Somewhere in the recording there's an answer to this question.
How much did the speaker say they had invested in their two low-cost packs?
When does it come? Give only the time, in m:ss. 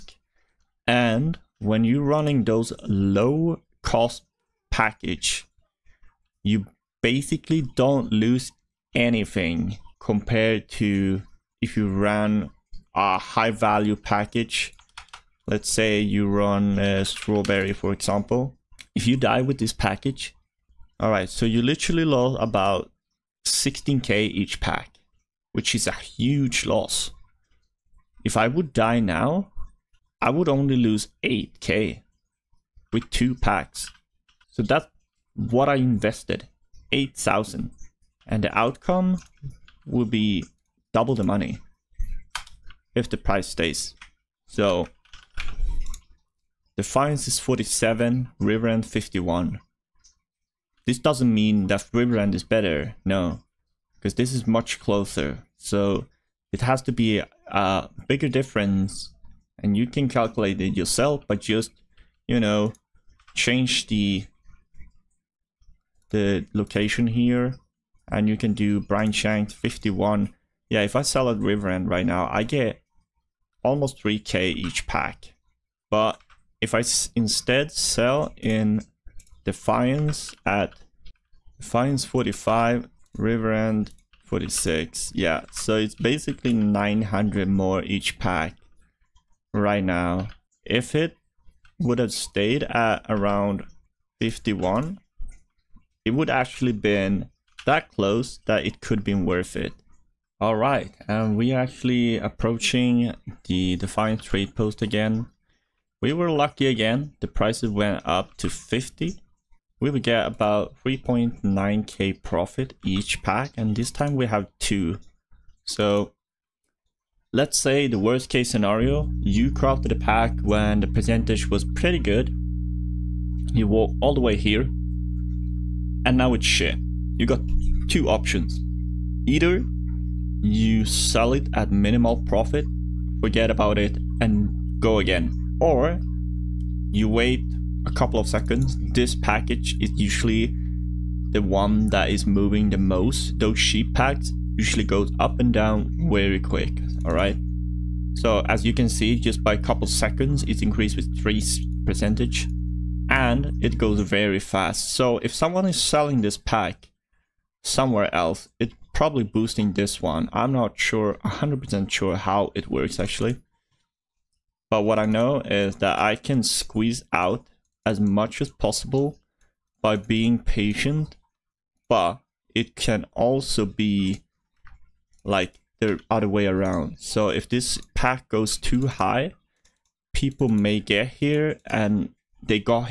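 0:36.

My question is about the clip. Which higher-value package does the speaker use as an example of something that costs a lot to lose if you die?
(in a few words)
Strawberry.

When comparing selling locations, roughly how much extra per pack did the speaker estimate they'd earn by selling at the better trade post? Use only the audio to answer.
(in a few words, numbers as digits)
900.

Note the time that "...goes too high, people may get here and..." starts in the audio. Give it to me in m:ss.
2:58.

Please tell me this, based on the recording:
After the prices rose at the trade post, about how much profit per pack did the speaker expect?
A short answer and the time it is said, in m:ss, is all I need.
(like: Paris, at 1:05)
3.9k, at 1:50.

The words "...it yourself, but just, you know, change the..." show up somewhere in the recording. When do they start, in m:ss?
1:00.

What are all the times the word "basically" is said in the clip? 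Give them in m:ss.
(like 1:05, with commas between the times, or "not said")
0:07, 1:25.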